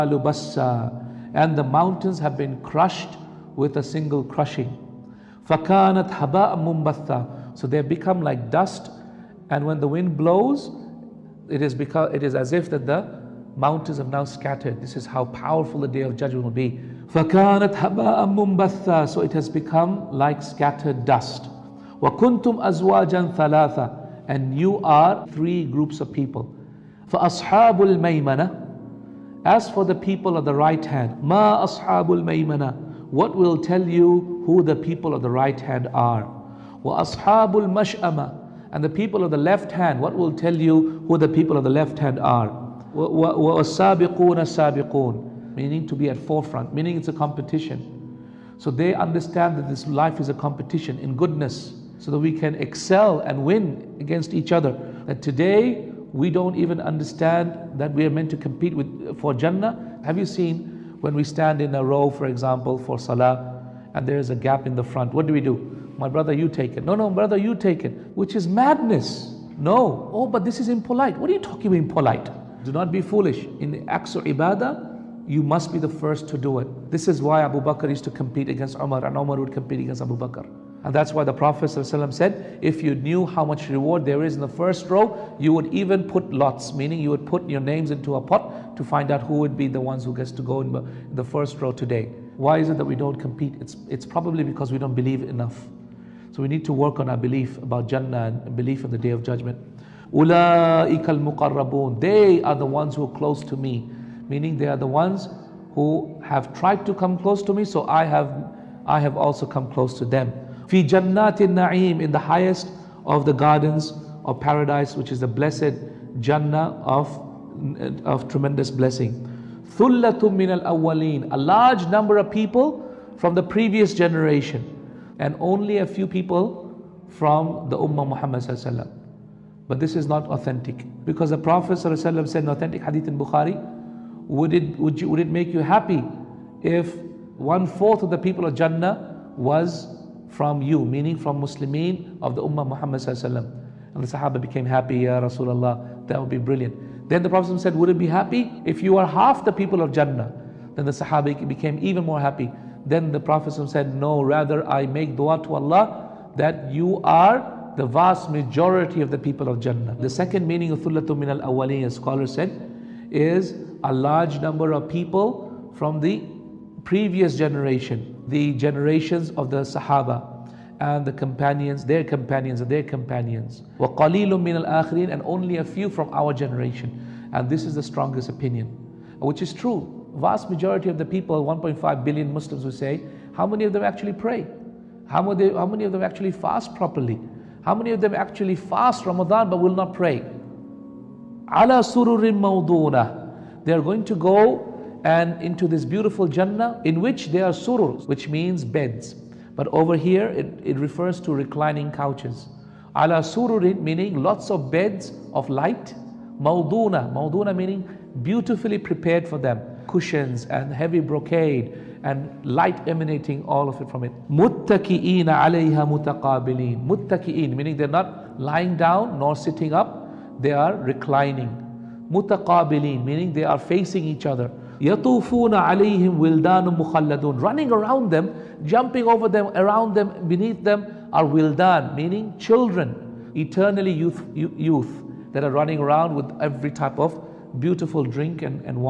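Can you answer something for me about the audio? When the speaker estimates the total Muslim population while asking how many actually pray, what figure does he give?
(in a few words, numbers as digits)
1.5 billion.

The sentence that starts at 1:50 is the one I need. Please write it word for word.
Fi جَنَّاتِ النَّعِيمِ In the highest of the gardens of paradise, which is the blessed Jannah of, of tremendous blessing.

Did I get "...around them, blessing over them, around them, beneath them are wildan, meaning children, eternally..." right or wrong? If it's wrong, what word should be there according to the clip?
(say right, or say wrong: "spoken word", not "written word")
wrong: "jumping", not "blessing".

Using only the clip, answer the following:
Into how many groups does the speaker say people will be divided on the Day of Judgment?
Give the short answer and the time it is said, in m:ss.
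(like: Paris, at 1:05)
3, at 0:25.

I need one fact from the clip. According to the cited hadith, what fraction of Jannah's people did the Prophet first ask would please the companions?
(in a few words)
One fourth.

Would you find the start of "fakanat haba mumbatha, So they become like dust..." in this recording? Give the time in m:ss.
0:05.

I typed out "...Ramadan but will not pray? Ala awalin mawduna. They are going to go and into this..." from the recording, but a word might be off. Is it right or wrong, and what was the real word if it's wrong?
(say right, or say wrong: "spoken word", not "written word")
wrong: "sururin", not "awalin".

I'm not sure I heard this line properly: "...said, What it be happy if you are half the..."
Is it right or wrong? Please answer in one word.
wrong.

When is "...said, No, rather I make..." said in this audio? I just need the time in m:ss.
2:33.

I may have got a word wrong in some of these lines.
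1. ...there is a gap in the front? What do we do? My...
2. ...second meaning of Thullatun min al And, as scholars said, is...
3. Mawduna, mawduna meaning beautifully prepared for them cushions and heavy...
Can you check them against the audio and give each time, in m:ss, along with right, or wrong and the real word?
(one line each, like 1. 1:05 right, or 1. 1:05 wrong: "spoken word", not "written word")
1. 1:04 right
2. 2:40 wrong: "Awali", not "And"
3. 3:26 right.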